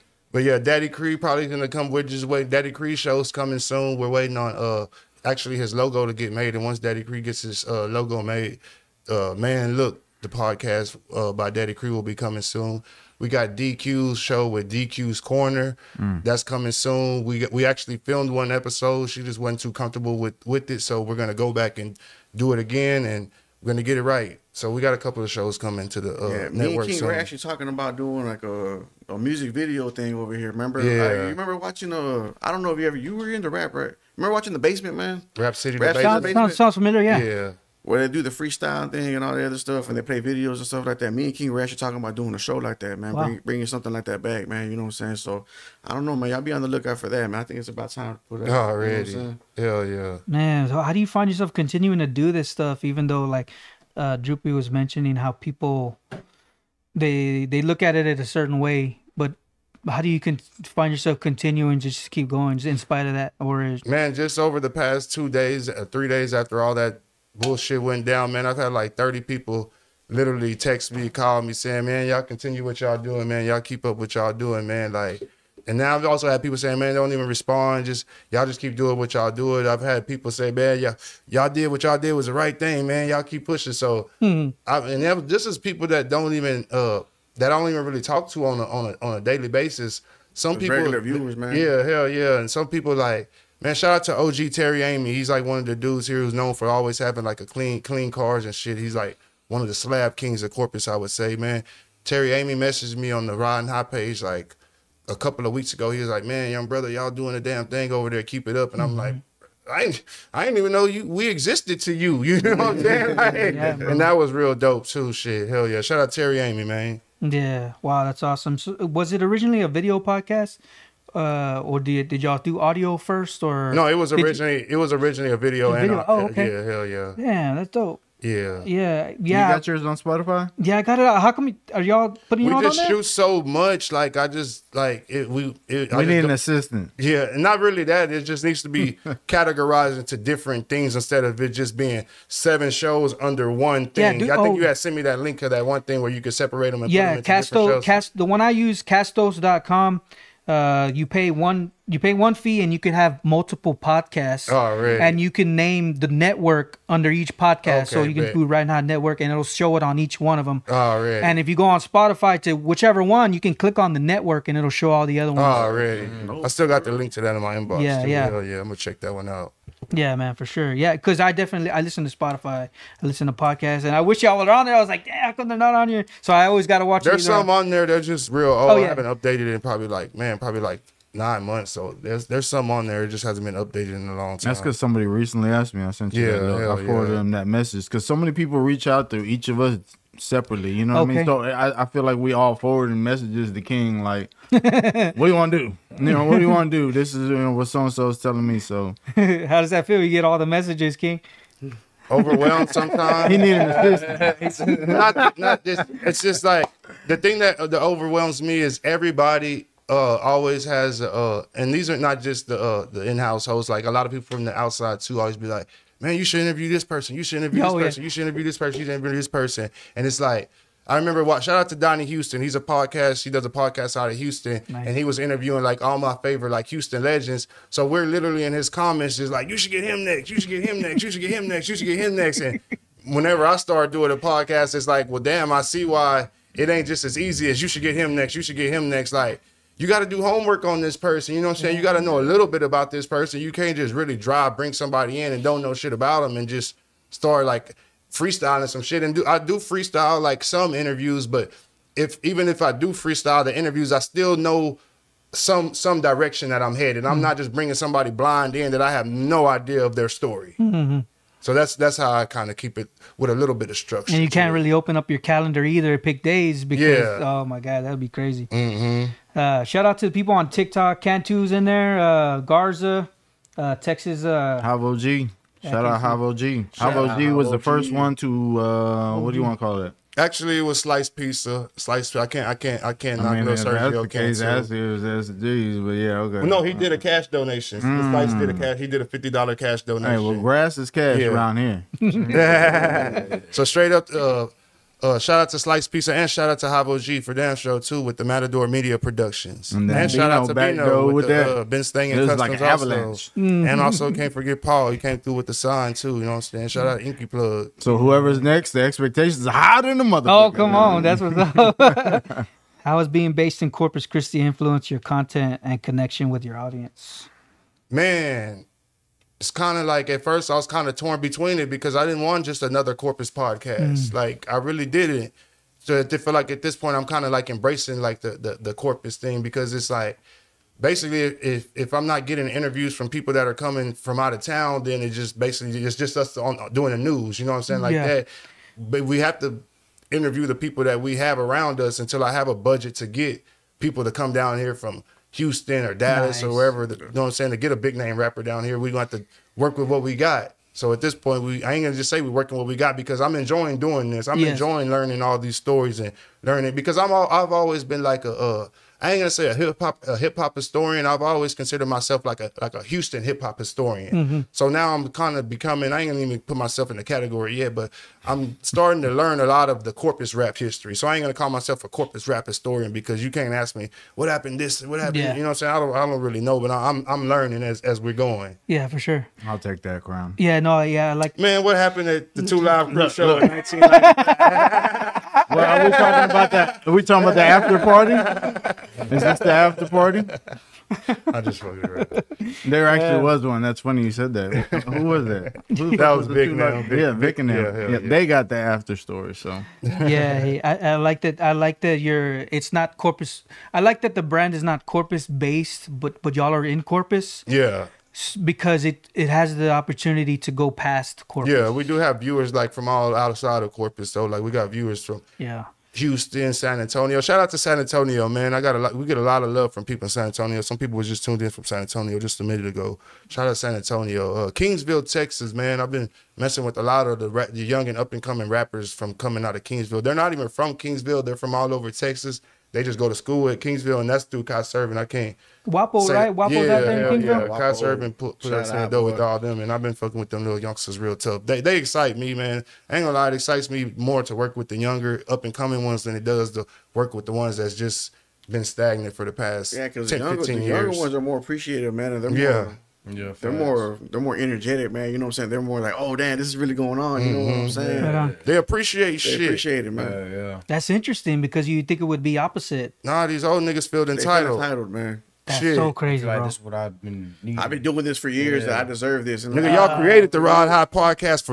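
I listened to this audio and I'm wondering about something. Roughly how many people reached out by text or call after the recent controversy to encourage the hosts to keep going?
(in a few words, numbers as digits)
30.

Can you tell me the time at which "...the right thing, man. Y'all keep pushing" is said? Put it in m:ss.
1:22.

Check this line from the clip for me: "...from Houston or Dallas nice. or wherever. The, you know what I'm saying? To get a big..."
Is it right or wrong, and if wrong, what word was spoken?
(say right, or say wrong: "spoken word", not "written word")
right.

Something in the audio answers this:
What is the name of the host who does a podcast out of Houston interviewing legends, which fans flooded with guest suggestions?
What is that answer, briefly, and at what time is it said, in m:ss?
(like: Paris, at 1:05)
Donnie Houston, at 3:41.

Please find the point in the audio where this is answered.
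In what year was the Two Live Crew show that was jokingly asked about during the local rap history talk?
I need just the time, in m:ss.
6:23.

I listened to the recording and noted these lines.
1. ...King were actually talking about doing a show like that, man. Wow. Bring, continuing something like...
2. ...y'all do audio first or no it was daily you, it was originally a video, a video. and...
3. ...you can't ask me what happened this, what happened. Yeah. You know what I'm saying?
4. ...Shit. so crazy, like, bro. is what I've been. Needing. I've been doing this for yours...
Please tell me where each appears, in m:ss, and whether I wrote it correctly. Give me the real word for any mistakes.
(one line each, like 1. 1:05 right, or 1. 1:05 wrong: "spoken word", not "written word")
1. 0:41 wrong: "bringing", not "continuing"
2. 2:02 wrong: "originally", not "daily"
3. 6:13 right
4. 7:45 wrong: "years", not "yours".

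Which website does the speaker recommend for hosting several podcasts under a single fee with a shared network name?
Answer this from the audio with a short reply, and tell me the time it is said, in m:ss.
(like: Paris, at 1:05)
castos.com, at 2:28.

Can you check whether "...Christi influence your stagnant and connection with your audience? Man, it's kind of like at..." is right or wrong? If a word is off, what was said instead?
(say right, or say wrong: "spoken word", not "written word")
wrong: "content", not "stagnant".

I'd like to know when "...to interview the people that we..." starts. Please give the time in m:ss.
5:39.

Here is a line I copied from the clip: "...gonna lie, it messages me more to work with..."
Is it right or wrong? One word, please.
wrong.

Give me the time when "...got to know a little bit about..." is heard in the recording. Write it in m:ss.
4:01.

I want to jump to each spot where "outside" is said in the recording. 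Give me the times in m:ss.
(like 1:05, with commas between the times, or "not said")
3:34, 6:53.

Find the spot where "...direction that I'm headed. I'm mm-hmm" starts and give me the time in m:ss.
4:16.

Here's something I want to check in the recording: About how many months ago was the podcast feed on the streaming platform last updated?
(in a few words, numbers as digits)
9.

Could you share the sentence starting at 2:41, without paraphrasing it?
And if you go on Spotify to whichever one, you can click on the network and it'll show all the other ones.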